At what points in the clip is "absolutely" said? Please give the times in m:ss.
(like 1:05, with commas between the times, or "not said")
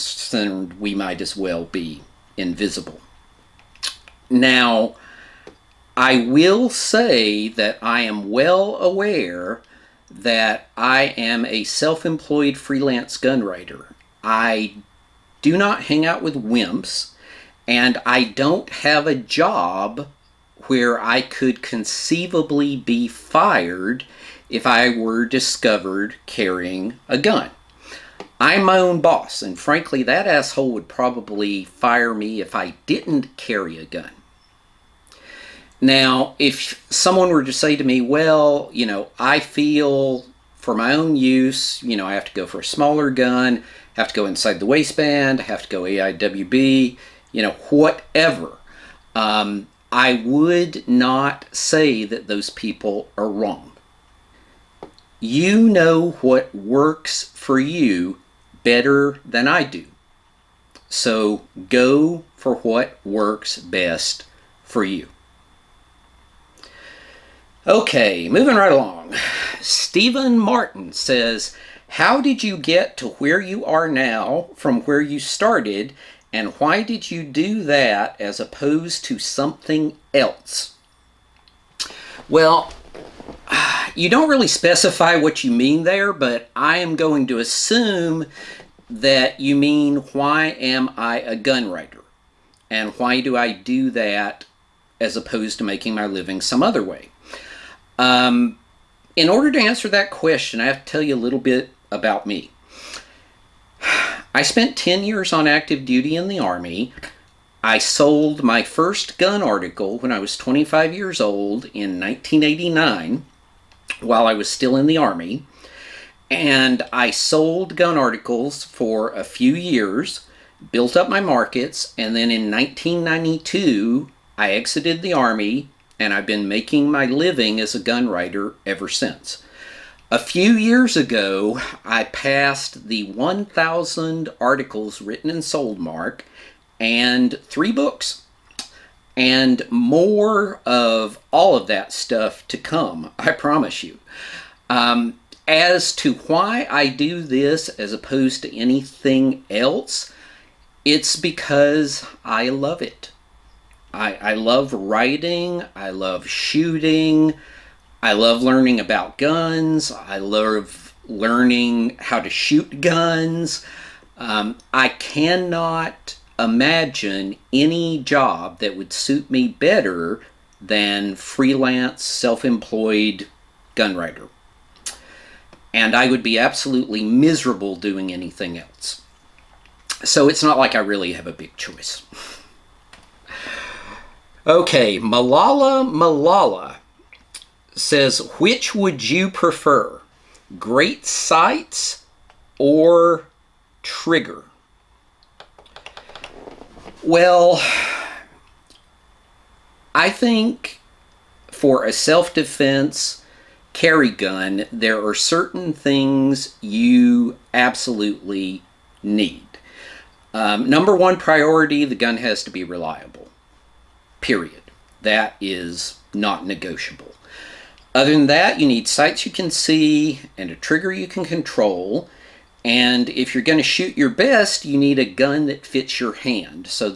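2:56, 3:27.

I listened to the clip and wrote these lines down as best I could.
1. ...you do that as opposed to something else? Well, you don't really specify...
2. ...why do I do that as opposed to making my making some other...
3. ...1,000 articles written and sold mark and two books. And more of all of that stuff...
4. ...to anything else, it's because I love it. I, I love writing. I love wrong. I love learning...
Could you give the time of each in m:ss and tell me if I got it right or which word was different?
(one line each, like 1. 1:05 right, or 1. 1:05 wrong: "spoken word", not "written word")
1. 1:17 right
2. 1:32 wrong: "living", not "making"
3. 2:13 wrong: "three", not "two"
4. 2:28 wrong: "shooting", not "wrong".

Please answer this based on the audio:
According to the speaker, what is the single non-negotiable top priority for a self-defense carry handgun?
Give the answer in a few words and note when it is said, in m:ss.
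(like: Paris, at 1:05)
Reliable, at 3:32.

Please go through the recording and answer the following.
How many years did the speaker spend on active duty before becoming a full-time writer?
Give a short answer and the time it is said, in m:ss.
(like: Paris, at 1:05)
10 years, at 1:44.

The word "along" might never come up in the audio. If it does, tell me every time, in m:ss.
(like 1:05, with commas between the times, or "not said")
1:08.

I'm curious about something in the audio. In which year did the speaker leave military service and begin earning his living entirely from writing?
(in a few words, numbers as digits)
1992.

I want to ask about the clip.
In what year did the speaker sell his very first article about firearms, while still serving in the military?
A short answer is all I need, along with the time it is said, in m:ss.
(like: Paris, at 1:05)
1989, at 1:52.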